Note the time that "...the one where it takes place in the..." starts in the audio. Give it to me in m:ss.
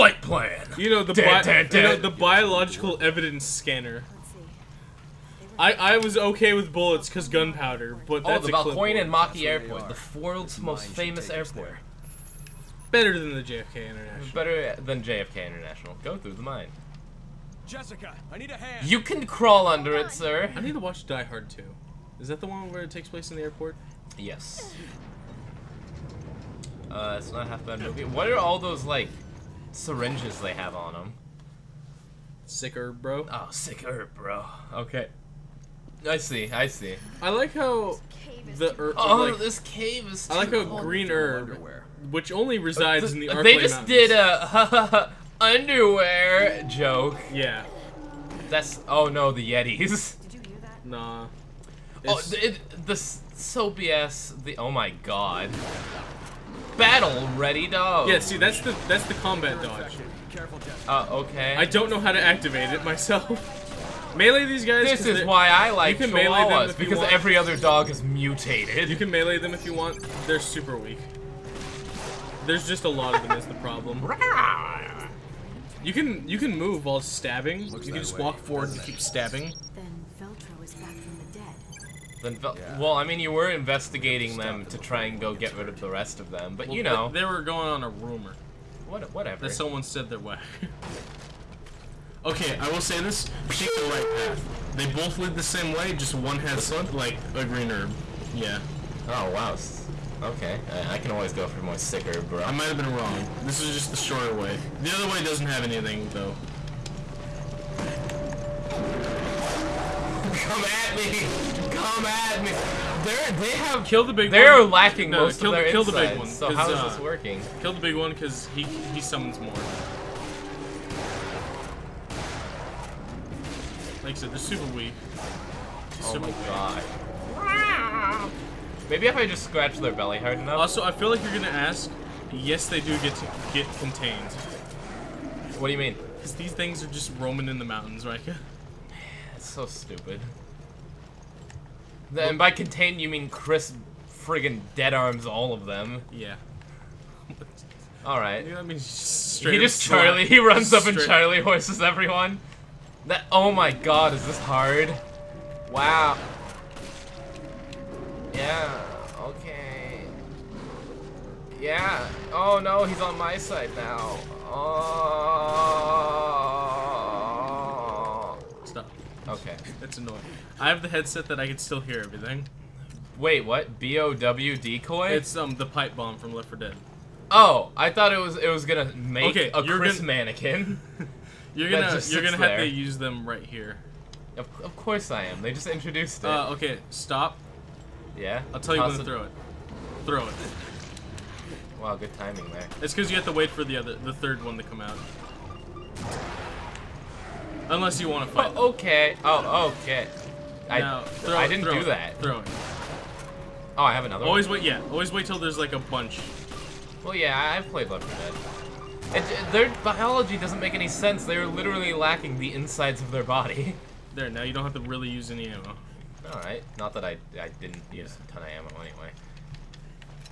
0:22.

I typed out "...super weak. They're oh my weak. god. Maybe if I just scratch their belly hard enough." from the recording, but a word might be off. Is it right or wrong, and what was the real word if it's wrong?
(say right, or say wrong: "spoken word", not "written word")
right.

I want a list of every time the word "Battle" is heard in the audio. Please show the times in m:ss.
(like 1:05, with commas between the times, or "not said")
0:56.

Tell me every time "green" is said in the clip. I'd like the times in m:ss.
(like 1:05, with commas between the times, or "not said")
0:40, 1:37.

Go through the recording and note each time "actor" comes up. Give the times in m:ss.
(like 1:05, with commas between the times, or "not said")
not said.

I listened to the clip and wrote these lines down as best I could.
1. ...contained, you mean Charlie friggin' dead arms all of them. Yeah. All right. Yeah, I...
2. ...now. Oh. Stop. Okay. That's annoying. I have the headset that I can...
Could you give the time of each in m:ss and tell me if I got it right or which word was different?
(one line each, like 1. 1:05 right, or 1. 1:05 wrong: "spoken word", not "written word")
1. 2:22 wrong: "Chris", not "Charlie"
2. 2:43 right.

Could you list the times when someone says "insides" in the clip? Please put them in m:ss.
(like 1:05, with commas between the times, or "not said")
1:55, 3:32.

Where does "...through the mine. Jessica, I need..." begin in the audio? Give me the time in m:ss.
0:16.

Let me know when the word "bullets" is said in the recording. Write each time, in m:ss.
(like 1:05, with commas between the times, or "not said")
0:06.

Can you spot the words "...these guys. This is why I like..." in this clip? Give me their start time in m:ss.
1:04.